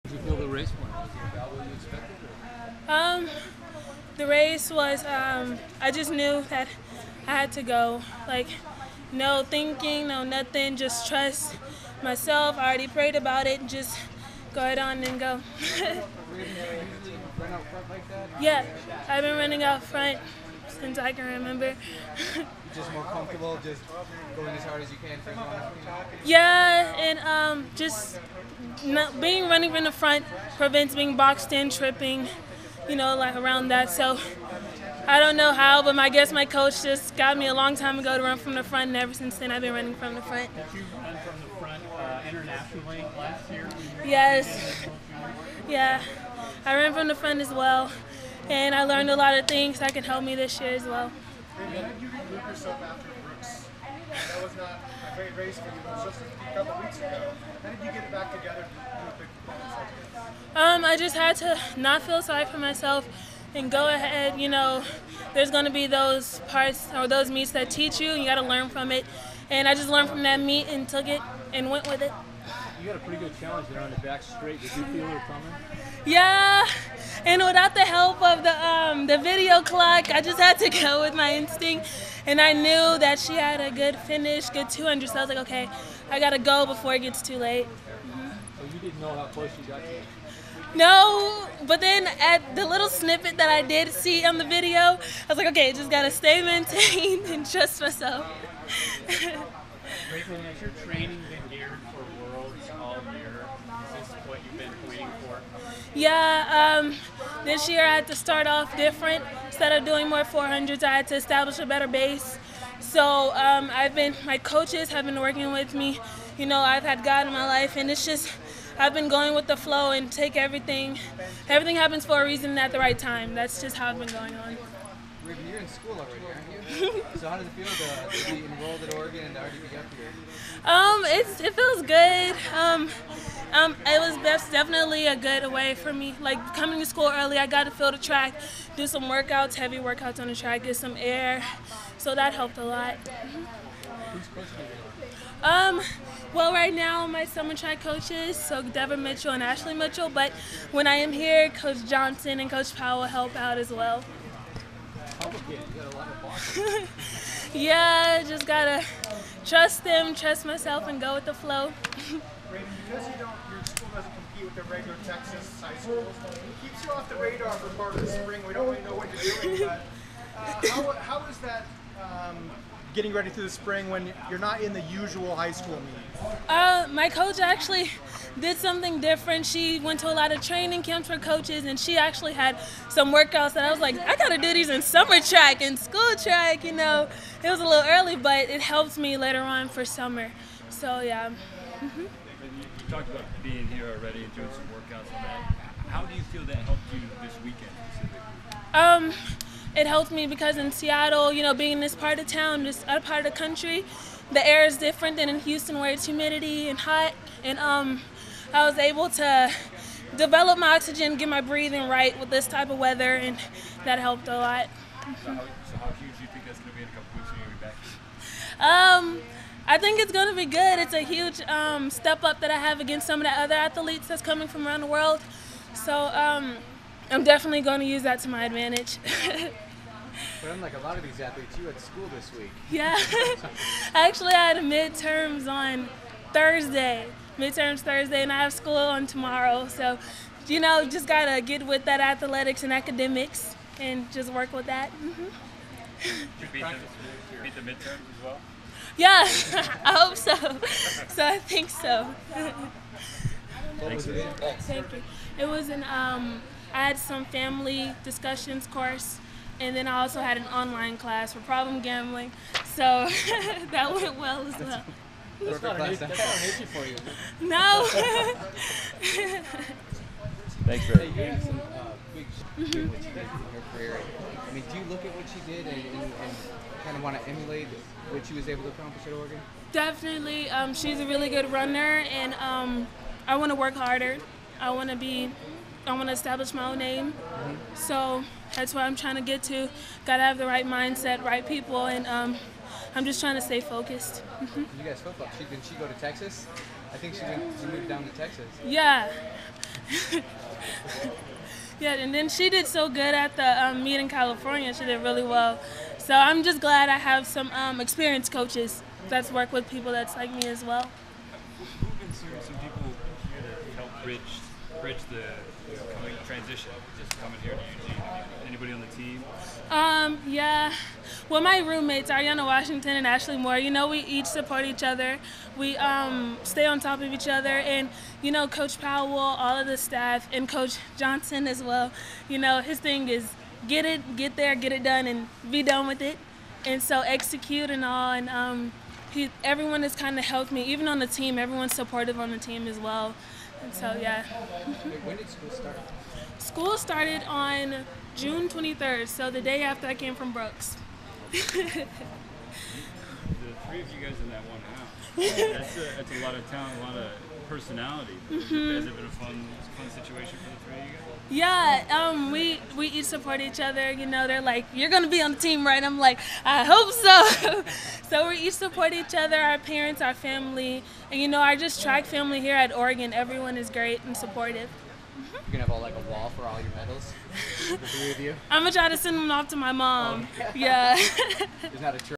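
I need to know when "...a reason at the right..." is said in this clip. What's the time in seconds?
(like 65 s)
122 s.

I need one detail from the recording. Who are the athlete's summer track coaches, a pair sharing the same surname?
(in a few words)
Devin Mitchell and Ashley Mitchell.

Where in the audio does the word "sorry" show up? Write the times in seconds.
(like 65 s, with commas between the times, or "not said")
62 s.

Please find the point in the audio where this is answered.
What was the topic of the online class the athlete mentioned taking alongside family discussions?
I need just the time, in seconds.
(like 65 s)
261 s.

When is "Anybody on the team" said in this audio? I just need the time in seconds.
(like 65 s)
318 s.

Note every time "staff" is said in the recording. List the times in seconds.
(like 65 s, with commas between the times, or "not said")
329 s.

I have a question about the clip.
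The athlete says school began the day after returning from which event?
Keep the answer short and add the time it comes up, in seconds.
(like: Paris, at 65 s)
Brooks, at 350 s.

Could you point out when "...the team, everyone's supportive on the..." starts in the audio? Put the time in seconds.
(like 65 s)
340 s.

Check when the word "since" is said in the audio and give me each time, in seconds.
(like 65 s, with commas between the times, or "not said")
20 s, 39 s.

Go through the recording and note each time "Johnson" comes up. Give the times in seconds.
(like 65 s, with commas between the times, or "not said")
151 s, 330 s.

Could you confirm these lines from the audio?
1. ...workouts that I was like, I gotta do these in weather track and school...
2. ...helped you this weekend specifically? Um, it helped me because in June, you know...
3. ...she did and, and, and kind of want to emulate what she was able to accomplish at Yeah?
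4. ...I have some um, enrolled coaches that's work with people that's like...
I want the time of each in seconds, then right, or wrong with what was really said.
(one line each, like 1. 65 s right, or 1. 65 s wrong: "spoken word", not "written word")
1. 183 s wrong: "summer", not "weather"
2. 196 s wrong: "Seattle", not "June"
3. 275 s wrong: "Oregon", not "Yeah"
4. 306 s wrong: "experienced", not "enrolled".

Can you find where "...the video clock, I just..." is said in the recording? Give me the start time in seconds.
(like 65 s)
79 s.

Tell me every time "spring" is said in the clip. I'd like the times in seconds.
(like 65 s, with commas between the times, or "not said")
168 s, 173 s.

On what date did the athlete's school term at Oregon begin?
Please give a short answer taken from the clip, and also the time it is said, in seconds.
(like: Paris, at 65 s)
June 23, at 348 s.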